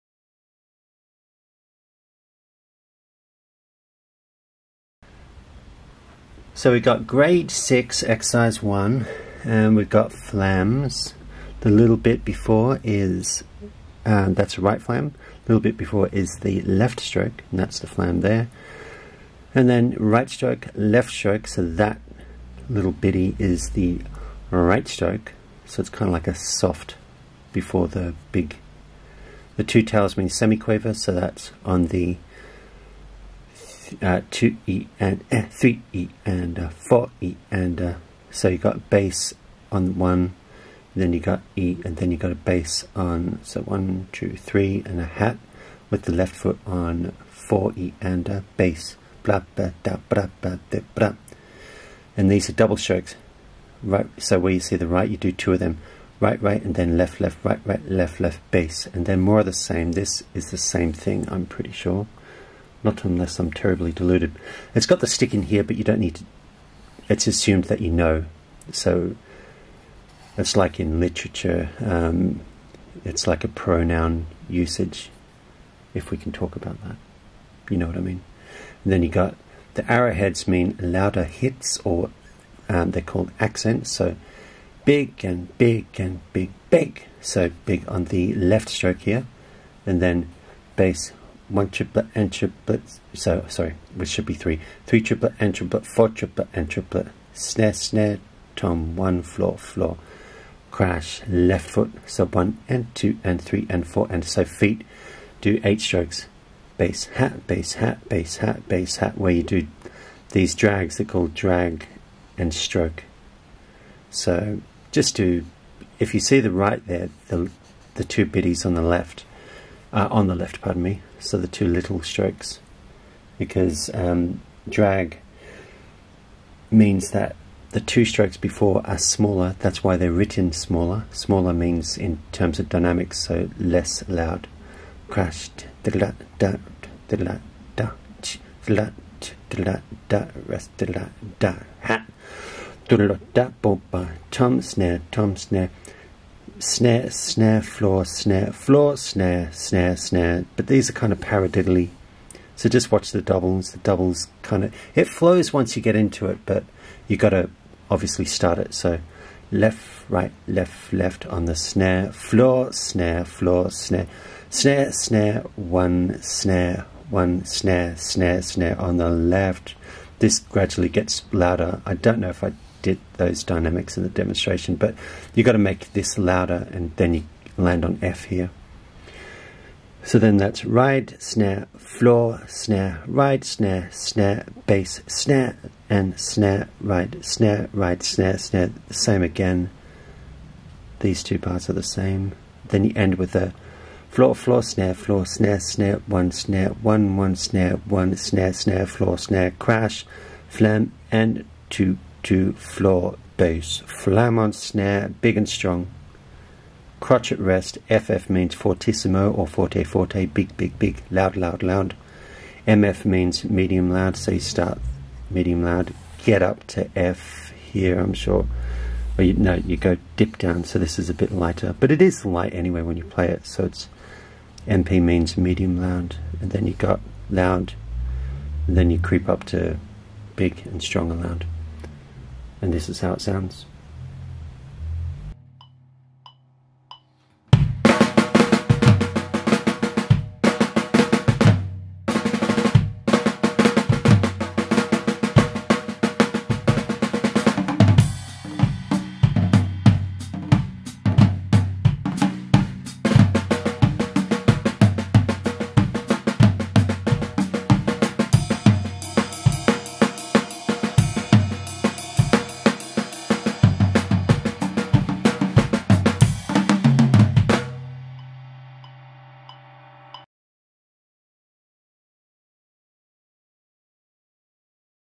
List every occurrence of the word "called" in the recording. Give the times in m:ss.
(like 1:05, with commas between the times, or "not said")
1:23, 1:51.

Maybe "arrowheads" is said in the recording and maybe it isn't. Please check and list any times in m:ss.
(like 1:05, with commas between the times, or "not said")
1:19.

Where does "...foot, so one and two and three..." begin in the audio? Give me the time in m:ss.
1:41.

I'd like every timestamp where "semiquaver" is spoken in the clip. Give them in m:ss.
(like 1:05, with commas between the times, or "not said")
0:30.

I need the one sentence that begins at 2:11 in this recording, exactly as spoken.
Smaller means in terms of dynamics, so less loud.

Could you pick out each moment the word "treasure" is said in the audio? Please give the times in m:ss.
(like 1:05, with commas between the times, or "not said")
not said.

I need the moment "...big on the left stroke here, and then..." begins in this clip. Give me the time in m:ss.
1:27.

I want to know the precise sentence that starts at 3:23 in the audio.
Flam on snare, big and strong.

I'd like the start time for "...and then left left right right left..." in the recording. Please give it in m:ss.
0:56.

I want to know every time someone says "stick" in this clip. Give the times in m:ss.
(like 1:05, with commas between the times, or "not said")
1:05.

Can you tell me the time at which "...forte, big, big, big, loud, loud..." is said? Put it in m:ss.
3:29.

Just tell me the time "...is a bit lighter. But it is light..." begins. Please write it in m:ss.
3:40.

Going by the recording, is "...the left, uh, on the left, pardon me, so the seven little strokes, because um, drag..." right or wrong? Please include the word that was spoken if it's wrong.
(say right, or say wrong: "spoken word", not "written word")
wrong: "two", not "seven".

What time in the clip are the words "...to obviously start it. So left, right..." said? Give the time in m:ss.
2:37.